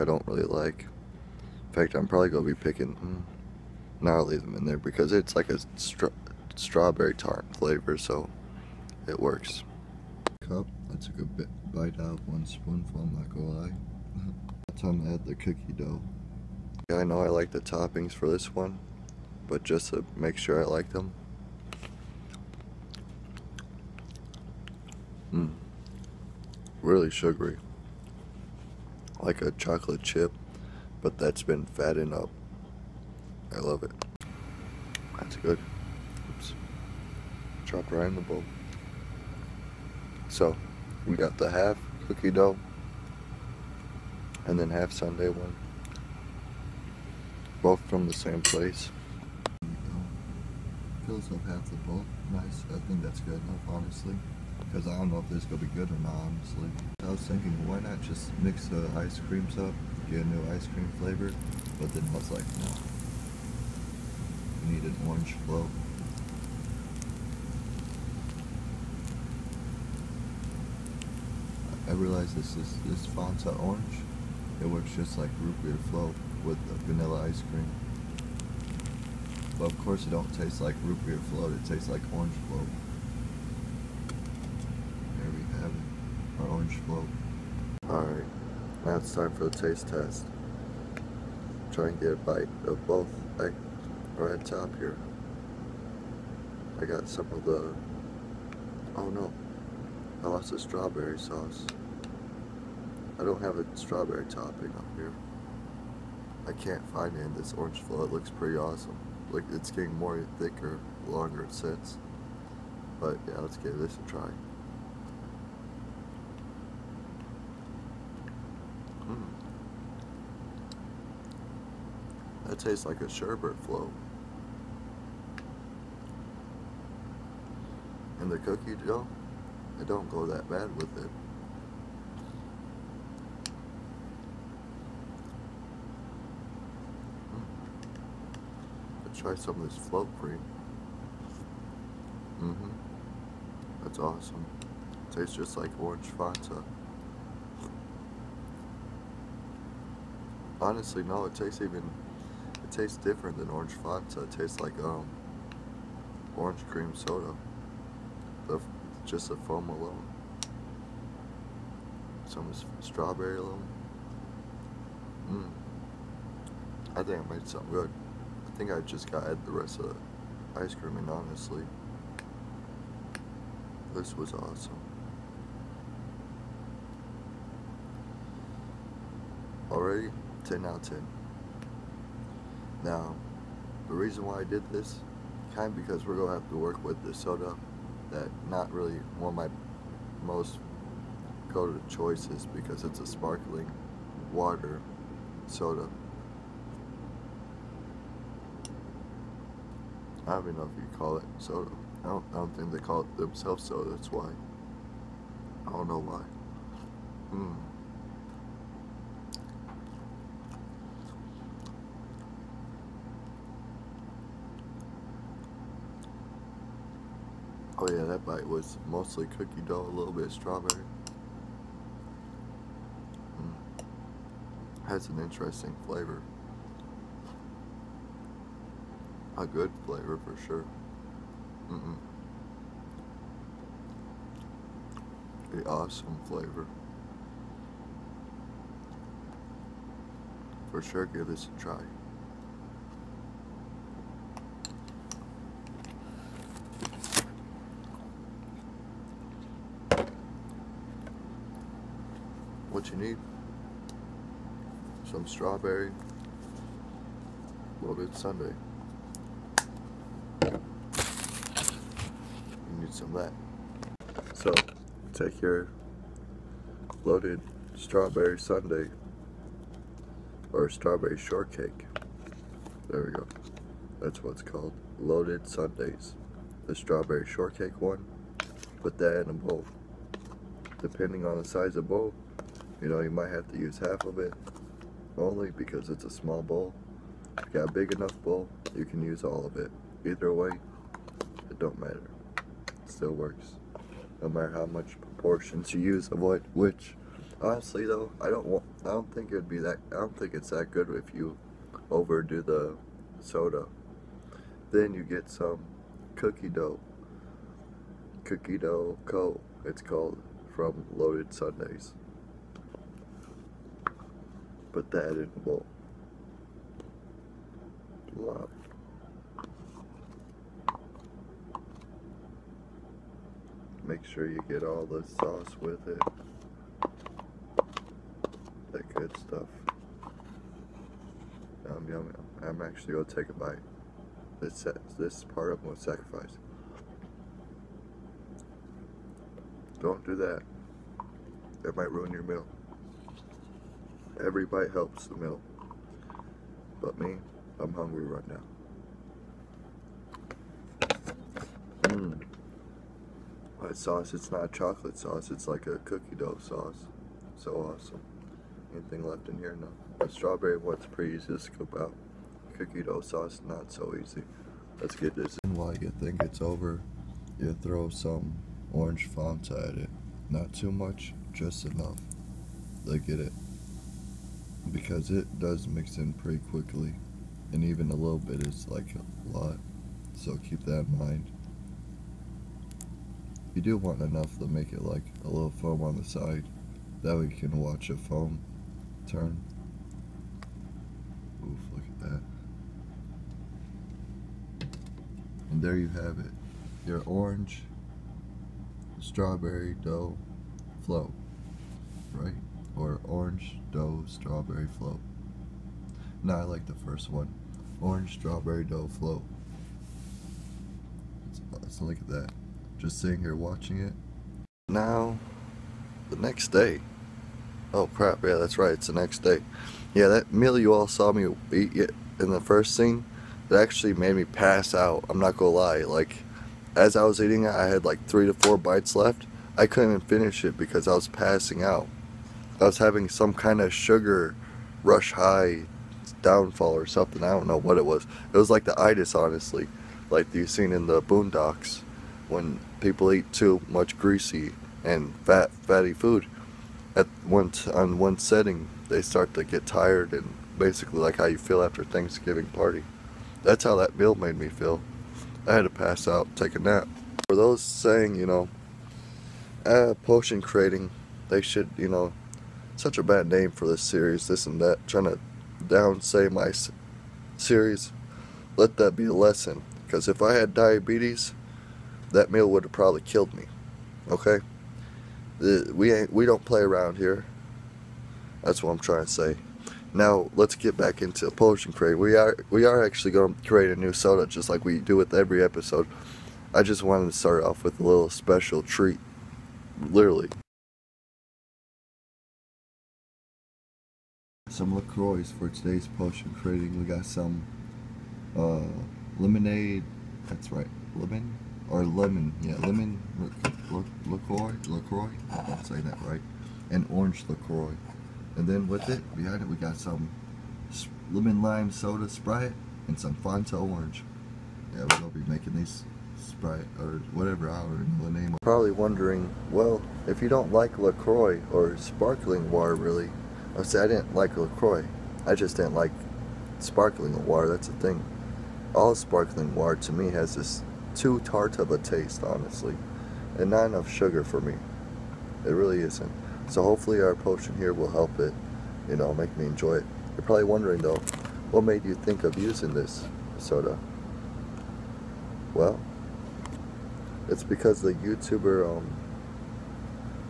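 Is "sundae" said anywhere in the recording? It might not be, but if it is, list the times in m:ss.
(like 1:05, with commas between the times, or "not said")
0:44, 4:18, 4:28, 4:35, 5:11.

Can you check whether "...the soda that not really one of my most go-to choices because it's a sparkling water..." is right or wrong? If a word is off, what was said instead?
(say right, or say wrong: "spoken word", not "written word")
right.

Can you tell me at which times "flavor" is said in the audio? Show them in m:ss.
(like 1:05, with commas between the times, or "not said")
0:07, 1:00, 3:45, 3:49, 3:56.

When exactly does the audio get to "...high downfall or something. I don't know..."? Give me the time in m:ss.
7:15.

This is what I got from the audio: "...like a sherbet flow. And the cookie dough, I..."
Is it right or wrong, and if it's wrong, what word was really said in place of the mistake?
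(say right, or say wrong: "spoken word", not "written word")
right.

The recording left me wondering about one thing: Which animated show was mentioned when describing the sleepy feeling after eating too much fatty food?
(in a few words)
The Boondocks.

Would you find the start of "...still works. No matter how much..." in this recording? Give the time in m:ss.
4:52.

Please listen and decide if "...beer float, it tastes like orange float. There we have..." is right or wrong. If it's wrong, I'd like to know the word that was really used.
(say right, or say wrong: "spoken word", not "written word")
right.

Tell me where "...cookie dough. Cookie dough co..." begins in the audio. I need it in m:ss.
5:06.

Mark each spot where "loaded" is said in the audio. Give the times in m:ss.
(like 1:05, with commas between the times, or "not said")
4:27, 4:34, 5:10.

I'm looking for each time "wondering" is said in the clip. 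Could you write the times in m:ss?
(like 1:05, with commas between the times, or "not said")
8:38, 9:00.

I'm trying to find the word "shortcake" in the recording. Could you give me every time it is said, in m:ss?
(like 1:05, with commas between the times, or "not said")
4:31, 4:37.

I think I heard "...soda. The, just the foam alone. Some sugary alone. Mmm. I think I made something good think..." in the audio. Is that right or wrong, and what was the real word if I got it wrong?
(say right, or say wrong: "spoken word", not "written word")
wrong: "strawberry", not "sugary".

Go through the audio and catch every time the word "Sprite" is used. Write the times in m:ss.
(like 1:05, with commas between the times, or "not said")
8:32, 8:36.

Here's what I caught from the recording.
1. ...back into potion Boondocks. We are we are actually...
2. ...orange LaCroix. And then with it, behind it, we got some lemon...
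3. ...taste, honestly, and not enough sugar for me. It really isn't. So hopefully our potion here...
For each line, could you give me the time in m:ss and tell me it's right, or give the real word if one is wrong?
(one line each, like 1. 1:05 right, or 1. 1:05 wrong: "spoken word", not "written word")
1. 8:00 wrong: "Crate", not "Boondocks"
2. 8:26 right
3. 8:51 right.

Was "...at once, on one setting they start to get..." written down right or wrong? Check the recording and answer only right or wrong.
right.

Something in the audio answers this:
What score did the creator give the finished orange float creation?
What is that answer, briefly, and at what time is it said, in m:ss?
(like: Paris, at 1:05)
10 out of 10, at 3:00.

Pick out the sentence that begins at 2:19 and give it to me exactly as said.
try some of this float cream.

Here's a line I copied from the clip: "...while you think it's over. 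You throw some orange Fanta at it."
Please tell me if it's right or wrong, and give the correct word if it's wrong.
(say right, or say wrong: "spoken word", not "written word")
right.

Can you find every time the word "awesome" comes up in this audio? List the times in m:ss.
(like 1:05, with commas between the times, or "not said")
1:48, 2:23, 2:54, 3:55, 5:57.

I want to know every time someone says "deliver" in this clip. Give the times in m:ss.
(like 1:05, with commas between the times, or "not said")
not said.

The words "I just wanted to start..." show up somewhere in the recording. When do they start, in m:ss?
8:06.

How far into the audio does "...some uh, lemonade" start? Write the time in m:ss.
8:17.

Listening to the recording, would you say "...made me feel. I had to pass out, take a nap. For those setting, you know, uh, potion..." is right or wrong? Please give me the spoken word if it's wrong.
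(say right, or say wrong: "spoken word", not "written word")
wrong: "saying", not "setting".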